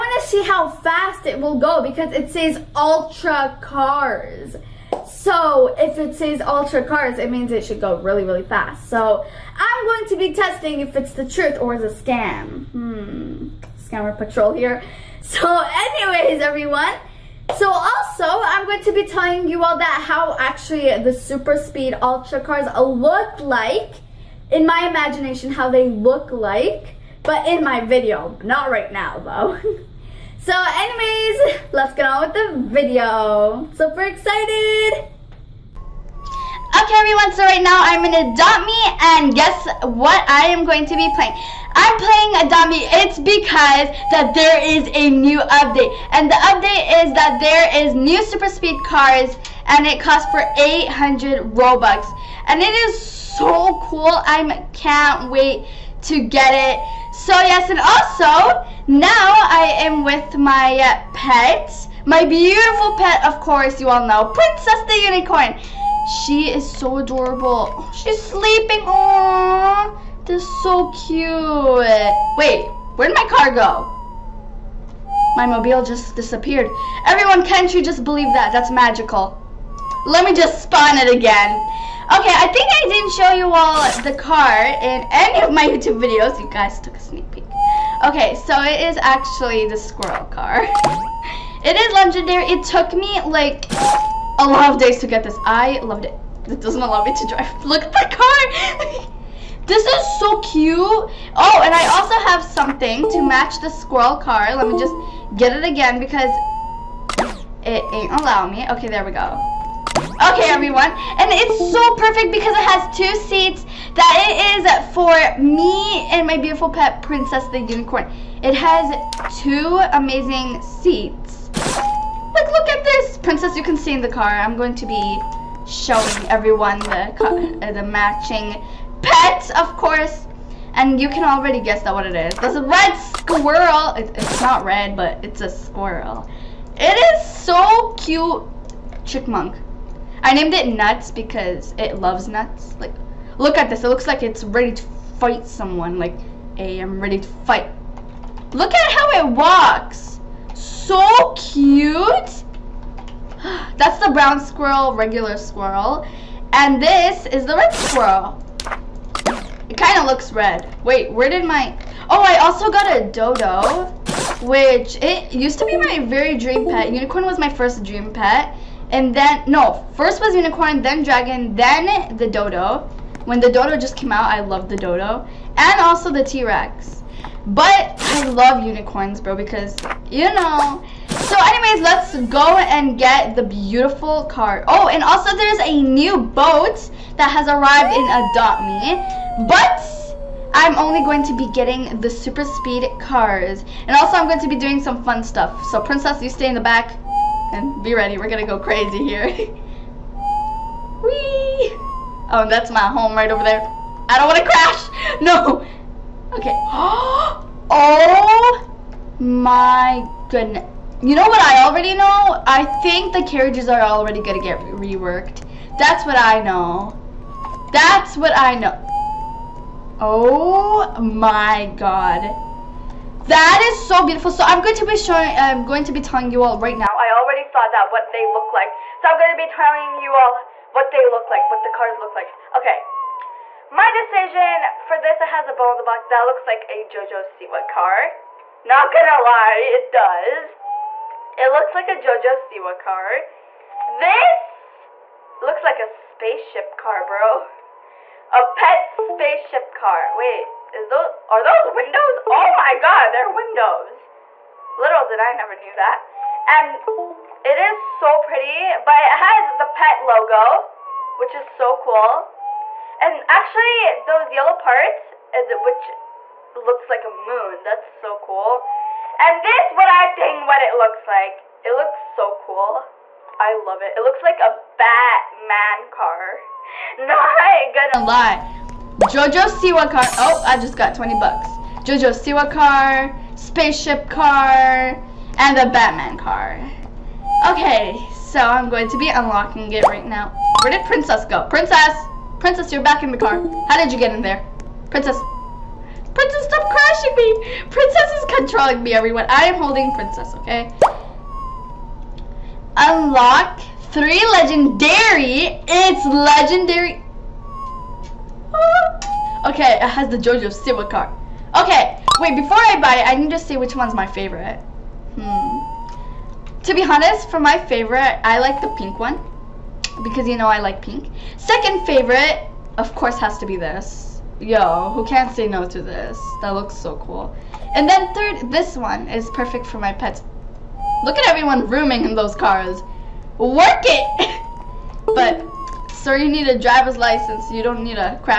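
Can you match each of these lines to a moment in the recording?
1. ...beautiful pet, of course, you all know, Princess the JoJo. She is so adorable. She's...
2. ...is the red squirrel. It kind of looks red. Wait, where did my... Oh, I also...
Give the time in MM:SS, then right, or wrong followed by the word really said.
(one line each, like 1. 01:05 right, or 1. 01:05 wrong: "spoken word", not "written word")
1. 01:02 wrong: "Unicorn", not "JoJo"
2. 02:37 right.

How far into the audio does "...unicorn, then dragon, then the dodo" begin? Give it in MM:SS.
02:50.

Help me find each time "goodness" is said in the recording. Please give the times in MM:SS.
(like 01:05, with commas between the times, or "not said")
03:30.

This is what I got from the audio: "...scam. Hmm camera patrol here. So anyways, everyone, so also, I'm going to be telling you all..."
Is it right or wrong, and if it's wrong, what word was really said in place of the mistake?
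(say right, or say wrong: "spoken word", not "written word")
right.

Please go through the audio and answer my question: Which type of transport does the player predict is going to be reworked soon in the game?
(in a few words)
Carriages.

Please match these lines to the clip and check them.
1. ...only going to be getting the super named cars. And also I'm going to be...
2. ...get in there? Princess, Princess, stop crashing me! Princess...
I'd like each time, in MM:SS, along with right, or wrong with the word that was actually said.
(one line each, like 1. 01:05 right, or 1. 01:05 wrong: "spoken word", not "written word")
1. 03:10 wrong: "speed", not "named"
2. 04:53 right.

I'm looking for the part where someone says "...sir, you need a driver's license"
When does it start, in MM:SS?
05:35.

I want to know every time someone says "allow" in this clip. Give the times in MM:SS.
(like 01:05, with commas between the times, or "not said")
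01:36, 01:48.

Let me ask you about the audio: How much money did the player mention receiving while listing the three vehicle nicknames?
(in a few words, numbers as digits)
20 bucks.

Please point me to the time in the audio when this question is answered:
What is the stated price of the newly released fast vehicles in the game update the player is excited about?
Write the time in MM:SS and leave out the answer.
00:50.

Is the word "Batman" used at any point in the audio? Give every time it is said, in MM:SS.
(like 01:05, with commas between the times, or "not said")
04:34, 04:45.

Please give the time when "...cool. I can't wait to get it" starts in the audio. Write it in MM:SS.
00:53.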